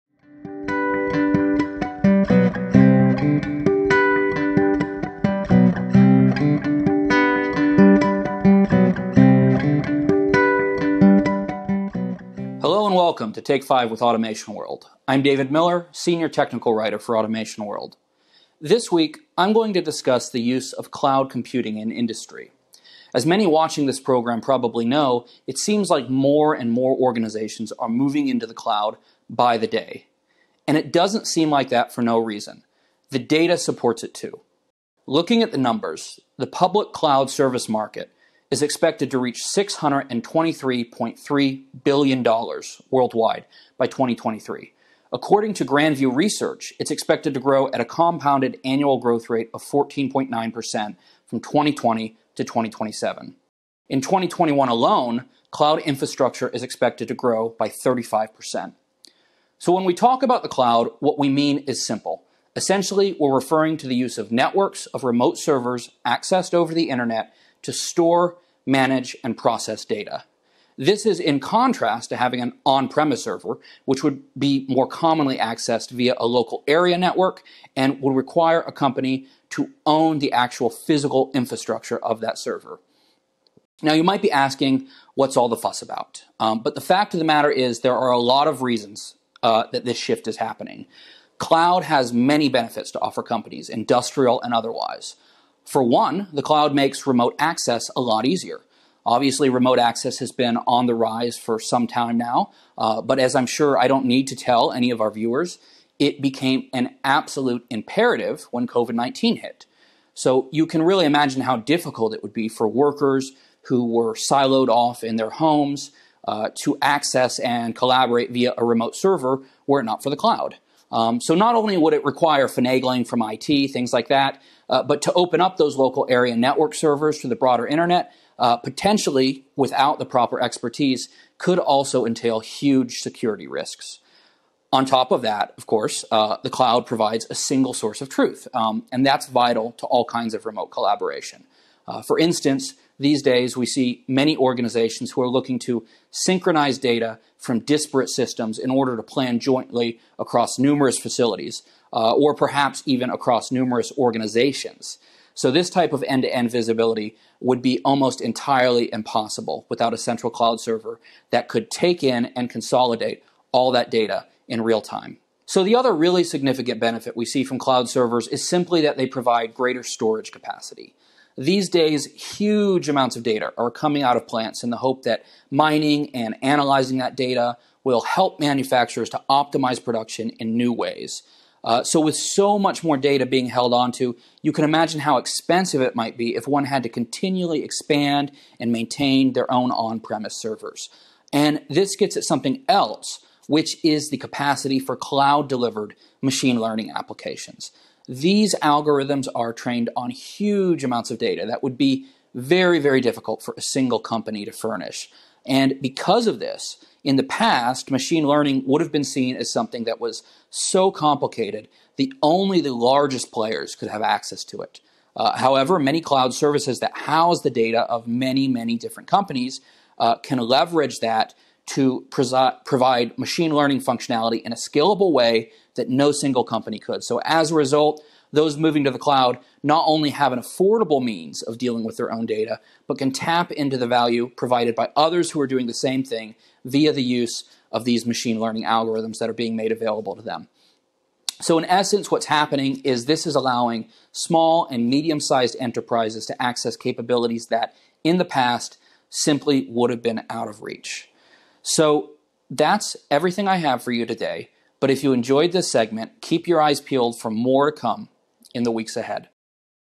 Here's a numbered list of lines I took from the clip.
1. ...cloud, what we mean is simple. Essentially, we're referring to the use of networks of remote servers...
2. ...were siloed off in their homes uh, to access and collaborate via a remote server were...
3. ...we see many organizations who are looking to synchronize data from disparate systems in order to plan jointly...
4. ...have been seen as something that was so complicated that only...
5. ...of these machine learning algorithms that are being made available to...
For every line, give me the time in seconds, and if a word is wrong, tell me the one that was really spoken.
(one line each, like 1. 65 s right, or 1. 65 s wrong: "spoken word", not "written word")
1. 60 s right
2. 113 s right
3. 143 s right
4. 208 s right
5. 237 s right.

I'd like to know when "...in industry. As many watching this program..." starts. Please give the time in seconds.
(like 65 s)
21 s.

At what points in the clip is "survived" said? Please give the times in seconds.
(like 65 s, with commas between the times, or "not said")
not said.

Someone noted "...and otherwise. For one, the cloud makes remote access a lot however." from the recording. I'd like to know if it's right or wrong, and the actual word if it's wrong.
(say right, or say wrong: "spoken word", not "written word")
wrong: "easier", not "however".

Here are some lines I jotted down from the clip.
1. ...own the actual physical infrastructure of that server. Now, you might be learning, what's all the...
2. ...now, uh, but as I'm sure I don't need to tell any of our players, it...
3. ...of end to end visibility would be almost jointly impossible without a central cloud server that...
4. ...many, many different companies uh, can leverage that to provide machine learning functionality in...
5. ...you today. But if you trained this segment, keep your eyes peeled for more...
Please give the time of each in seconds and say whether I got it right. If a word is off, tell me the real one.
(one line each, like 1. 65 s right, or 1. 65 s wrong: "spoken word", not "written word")
1. 79 s wrong: "asking", not "learning"
2. 102 s wrong: "viewers", not "players"
3. 155 s wrong: "entirely", not "jointly"
4. 218 s right
5. 253 s wrong: "enjoyed", not "trained".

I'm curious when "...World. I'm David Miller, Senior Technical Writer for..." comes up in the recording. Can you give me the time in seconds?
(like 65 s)
14 s.